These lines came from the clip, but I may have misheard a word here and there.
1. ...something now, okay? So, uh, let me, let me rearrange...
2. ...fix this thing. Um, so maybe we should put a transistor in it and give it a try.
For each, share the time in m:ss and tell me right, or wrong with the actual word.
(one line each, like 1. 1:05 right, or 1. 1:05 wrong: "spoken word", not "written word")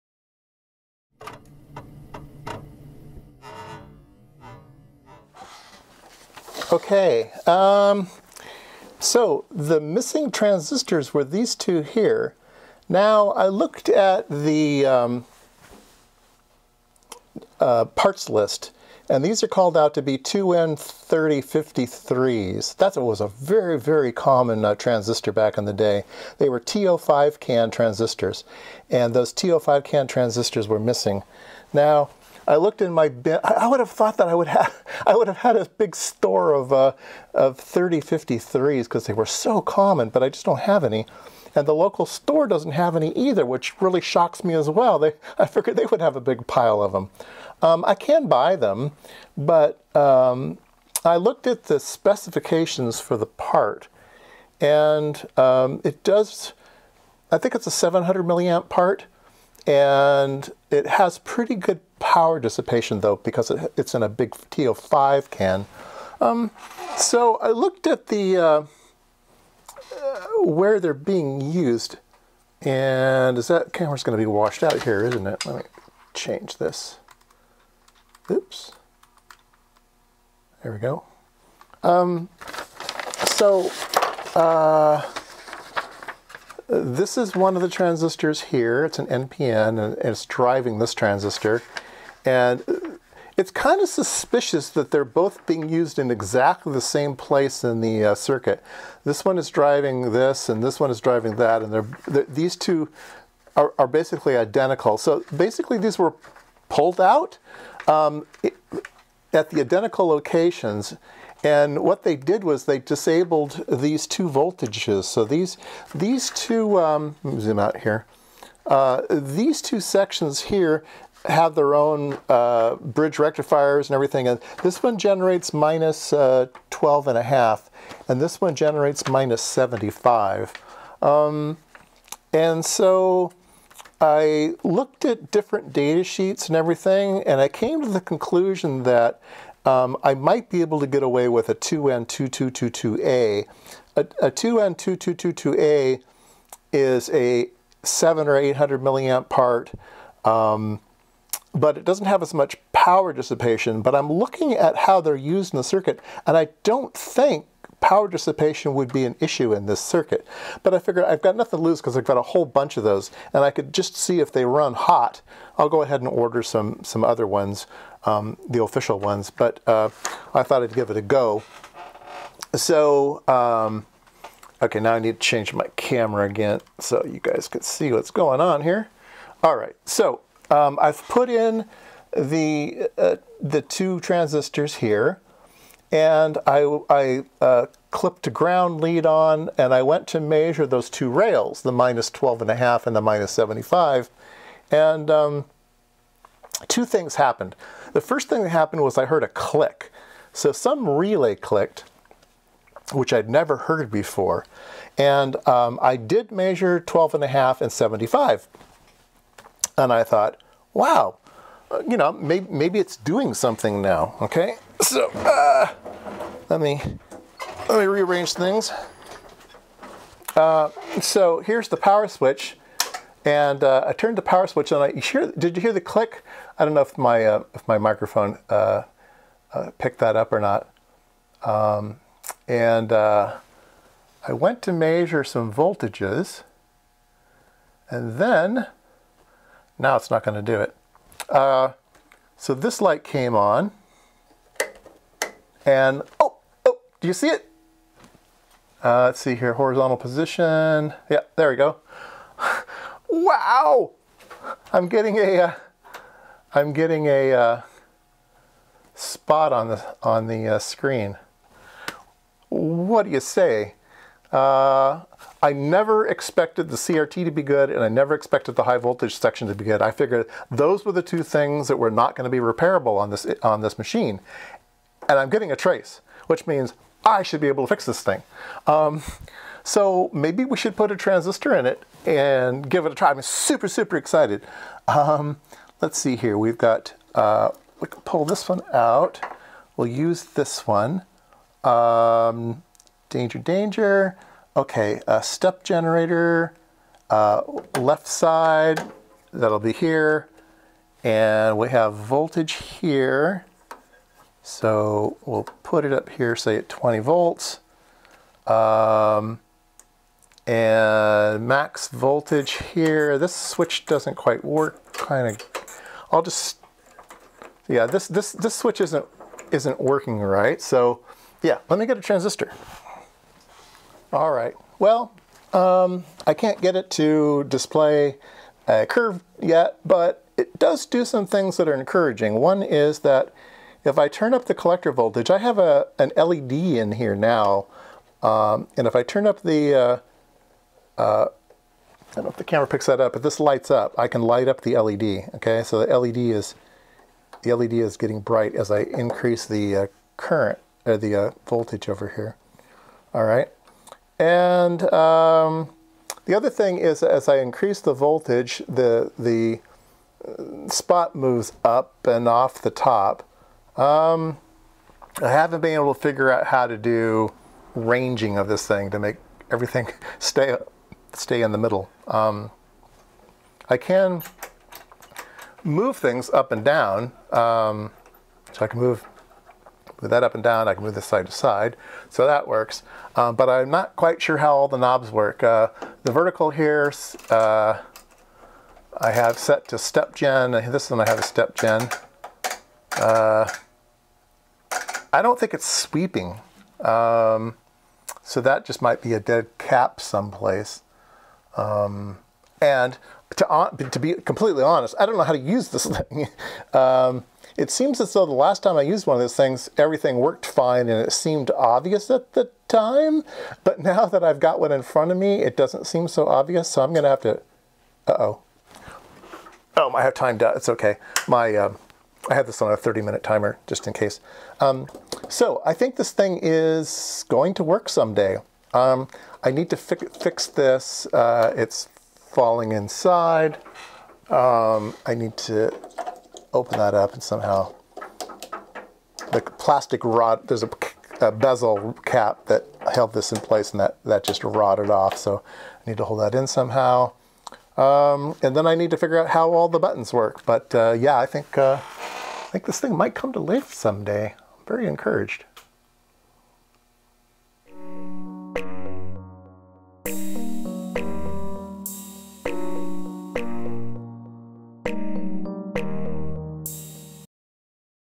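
1. 3:33 right
2. 4:37 right.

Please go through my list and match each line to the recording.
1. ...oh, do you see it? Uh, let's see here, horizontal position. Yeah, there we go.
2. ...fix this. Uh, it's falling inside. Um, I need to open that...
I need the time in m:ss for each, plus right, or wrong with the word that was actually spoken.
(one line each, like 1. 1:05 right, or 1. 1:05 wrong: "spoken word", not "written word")
1. 4:06 right
2. 7:09 right.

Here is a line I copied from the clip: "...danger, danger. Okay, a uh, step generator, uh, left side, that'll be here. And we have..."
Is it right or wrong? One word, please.
right.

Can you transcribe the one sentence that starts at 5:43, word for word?
I can light up the LED, okay?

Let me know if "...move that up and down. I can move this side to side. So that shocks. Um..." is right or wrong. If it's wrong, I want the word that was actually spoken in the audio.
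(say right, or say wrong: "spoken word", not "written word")
wrong: "works", not "shocks".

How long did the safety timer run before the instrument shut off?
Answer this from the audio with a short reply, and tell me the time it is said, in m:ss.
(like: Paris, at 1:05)
30 minutes, at 7:02.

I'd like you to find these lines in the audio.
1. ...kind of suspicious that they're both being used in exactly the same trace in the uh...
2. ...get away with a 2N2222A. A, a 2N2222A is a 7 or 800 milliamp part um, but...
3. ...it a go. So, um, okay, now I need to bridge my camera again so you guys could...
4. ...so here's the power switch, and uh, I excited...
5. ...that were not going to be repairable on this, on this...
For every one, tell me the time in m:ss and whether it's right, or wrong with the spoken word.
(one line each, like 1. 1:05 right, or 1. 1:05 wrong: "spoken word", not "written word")
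1. 1:33 wrong: "place", not "trace"
2. 2:20 right
3. 2:50 wrong: "change", not "bridge"
4. 3:41 wrong: "turned", not "excited"
5. 4:31 right.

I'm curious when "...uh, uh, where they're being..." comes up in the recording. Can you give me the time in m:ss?
1:08.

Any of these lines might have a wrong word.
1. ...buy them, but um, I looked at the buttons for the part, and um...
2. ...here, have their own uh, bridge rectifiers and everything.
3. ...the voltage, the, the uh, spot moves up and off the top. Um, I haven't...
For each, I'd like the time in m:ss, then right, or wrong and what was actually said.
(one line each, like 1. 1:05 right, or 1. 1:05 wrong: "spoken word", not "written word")
1. 0:48 wrong: "specifications", not "buttons"
2. 2:00 right
3. 5:57 right.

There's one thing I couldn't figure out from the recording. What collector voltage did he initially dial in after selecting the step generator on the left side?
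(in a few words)
20 volts.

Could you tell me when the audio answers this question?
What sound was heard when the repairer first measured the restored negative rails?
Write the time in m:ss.
3:18.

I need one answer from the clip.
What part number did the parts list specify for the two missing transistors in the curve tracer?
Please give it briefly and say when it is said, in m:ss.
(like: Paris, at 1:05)
2N3053, at 0:20.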